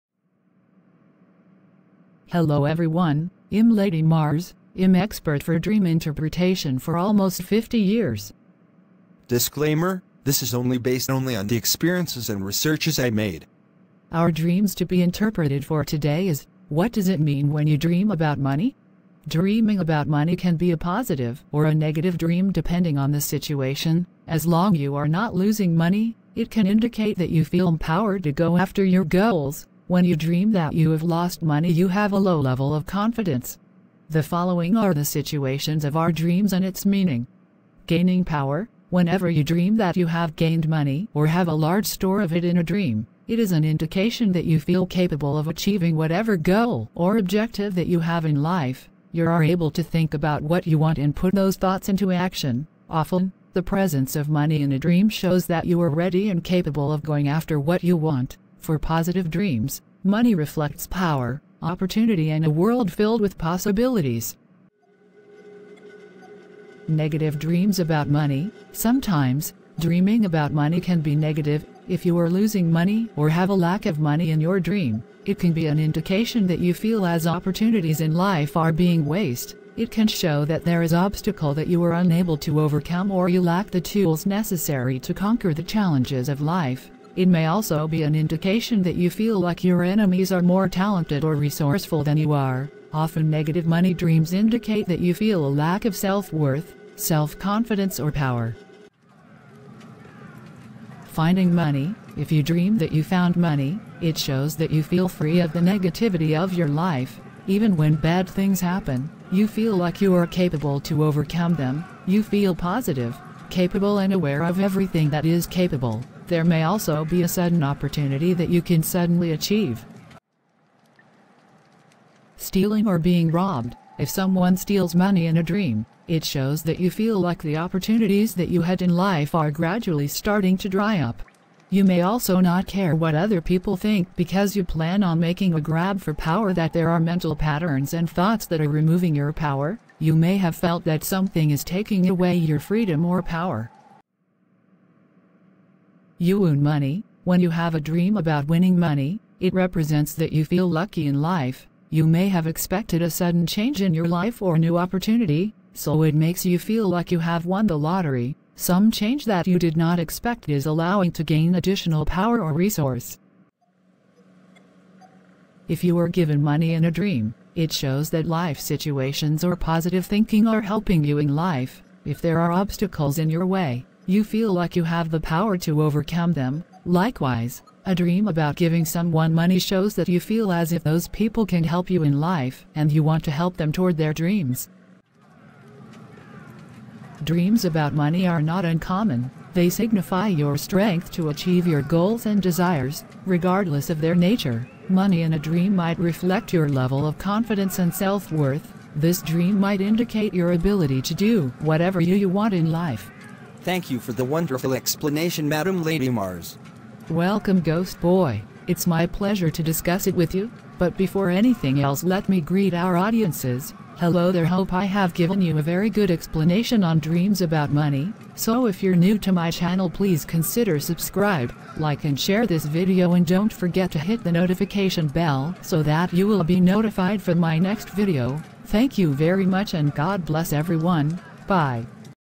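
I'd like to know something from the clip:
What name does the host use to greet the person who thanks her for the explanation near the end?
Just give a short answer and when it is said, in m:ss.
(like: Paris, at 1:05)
Ghost Boy, at 3:27.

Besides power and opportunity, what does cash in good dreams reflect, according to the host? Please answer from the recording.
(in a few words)
A world filled with possibilities.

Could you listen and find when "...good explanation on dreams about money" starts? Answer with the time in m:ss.
3:35.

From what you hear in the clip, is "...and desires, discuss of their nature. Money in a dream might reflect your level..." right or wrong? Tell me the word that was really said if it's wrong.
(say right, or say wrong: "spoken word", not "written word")
wrong: "regardless", not "discuss".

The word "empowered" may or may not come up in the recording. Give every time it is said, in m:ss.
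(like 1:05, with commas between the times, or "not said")
0:27.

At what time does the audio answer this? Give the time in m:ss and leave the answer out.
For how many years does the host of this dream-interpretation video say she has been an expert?
0:06.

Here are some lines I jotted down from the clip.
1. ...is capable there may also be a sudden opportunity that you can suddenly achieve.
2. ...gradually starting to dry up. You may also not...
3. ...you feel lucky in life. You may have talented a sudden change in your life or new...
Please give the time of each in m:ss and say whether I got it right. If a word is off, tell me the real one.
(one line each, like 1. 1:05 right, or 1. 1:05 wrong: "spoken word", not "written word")
1. 1:55 right
2. 2:09 right
3. 2:30 wrong: "expected", not "talented".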